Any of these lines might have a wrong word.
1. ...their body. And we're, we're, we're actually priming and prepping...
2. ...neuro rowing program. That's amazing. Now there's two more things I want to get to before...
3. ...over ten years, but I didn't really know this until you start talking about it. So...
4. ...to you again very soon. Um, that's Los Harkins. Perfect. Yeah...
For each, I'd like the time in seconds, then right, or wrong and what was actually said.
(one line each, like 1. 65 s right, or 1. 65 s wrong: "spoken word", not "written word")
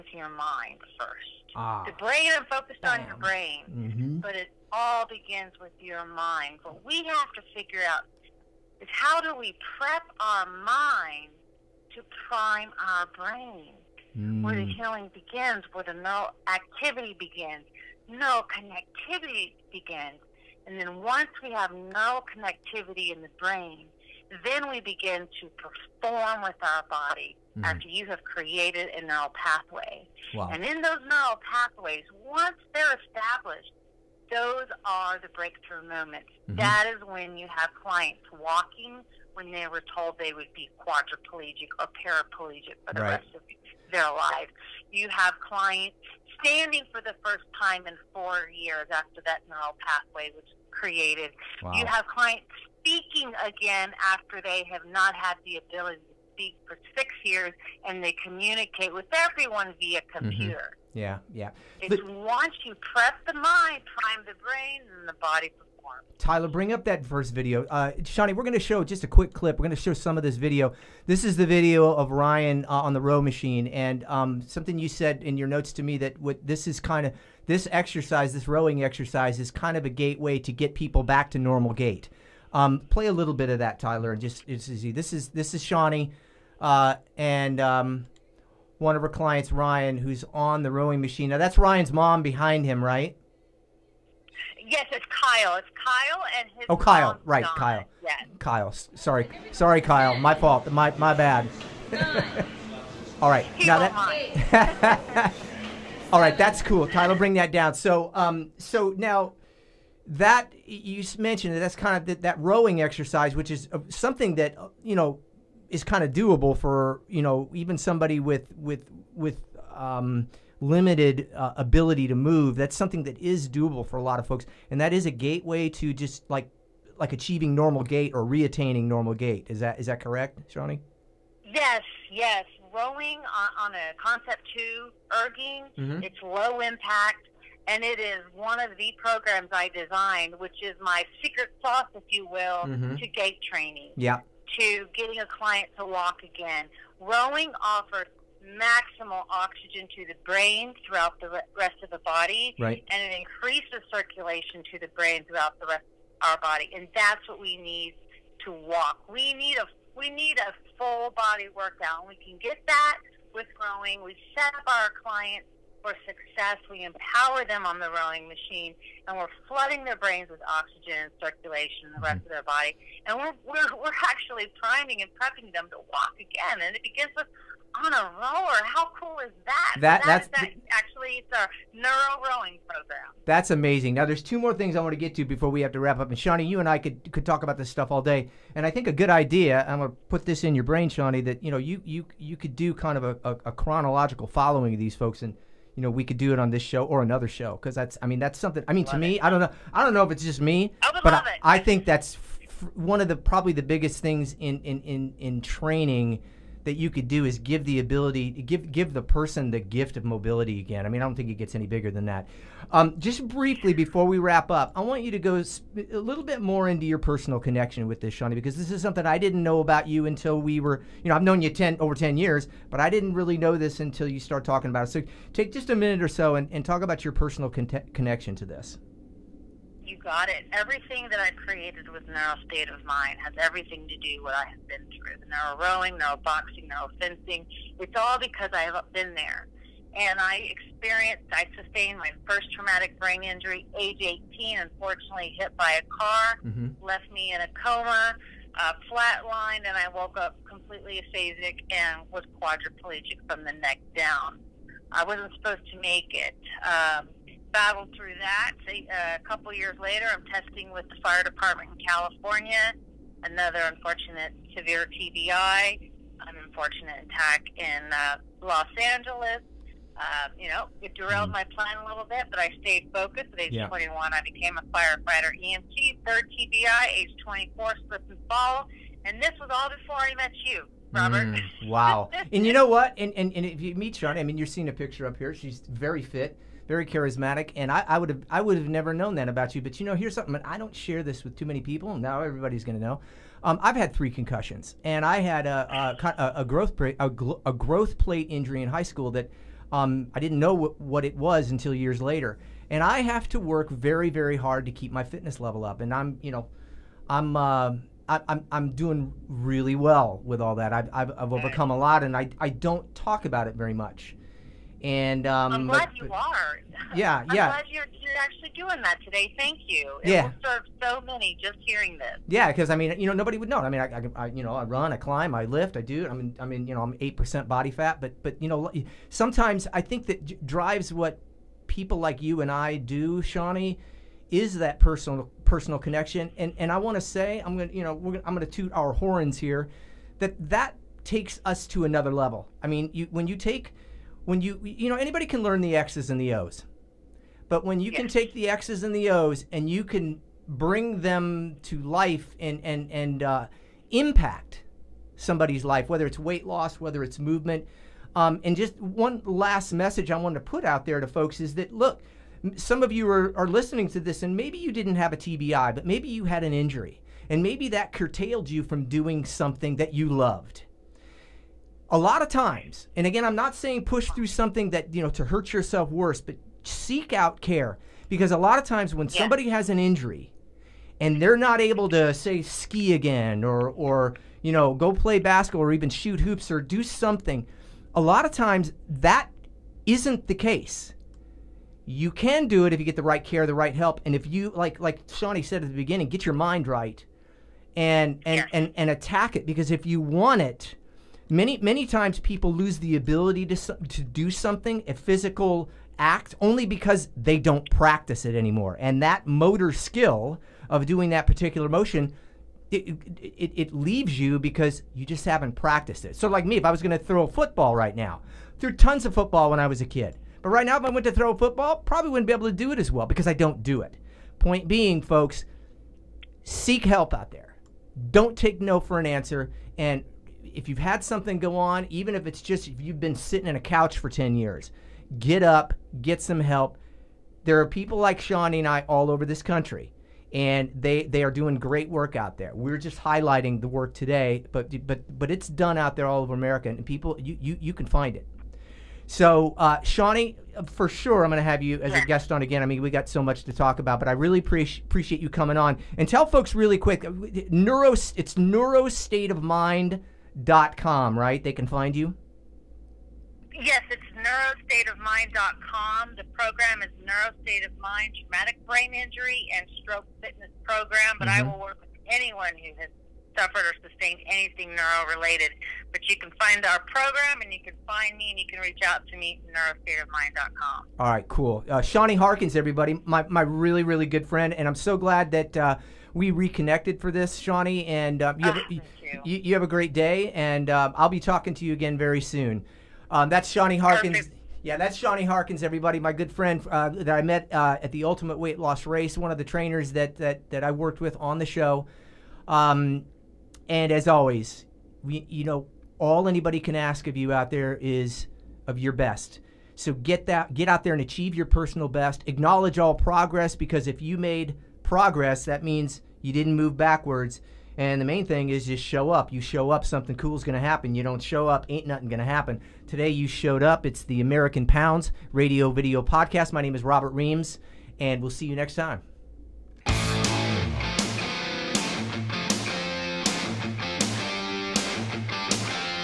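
1. 172 s right
2. 181 s right
3. 221 s right
4. 491 s wrong: "Shawnee", not "Los".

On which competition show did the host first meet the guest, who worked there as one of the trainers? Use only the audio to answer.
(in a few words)
Ultimate Weight Loss Race.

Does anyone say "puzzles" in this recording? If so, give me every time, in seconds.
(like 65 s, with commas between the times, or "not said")
not said.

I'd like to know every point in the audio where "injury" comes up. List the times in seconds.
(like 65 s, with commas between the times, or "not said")
243 s, 298 s, 366 s, 379 s, 468 s.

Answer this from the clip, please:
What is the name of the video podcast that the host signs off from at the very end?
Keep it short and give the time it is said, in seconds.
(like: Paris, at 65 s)
American Pounds Radio, at 524 s.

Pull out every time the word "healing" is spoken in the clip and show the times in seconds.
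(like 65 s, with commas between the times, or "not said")
14 s.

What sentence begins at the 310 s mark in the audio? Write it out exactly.
I've, I've, I've overcome a lot, and I, I don't talk about it very much.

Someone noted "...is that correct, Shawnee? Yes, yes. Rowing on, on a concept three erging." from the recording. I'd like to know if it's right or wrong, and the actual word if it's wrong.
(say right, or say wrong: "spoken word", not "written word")
wrong: "two", not "three".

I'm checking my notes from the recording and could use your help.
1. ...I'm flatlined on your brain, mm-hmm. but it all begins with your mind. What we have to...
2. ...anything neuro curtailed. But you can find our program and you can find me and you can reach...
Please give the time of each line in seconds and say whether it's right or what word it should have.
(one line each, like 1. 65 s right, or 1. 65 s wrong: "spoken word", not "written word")
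1. 2 s wrong: "focused", not "flatlined"
2. 474 s wrong: "related", not "curtailed".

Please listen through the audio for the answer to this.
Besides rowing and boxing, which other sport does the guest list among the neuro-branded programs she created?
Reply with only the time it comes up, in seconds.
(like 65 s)
236 s.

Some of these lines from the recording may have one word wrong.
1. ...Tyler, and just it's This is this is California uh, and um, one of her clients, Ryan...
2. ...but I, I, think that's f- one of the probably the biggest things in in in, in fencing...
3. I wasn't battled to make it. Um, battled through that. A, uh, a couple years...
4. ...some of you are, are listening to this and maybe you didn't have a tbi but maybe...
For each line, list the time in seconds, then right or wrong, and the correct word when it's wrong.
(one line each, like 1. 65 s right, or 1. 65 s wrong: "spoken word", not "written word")
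1. 83 s wrong: "Shawnee", not "California"
2. 201 s wrong: "training", not "fencing"
3. 254 s wrong: "supposed", not "battled"
4. 362 s right.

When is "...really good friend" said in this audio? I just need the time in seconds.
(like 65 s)
483 s.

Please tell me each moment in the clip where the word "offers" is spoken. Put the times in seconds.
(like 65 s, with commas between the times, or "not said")
147 s.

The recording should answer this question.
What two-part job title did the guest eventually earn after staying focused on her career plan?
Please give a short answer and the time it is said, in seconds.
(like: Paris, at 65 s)
Firefighter EMT, at 274 s.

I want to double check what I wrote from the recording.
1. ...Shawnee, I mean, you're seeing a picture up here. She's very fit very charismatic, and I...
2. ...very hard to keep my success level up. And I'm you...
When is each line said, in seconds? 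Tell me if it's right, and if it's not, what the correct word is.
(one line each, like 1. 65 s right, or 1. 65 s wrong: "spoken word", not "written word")
1. 283 s right
2. 304 s wrong: "fitness", not "success".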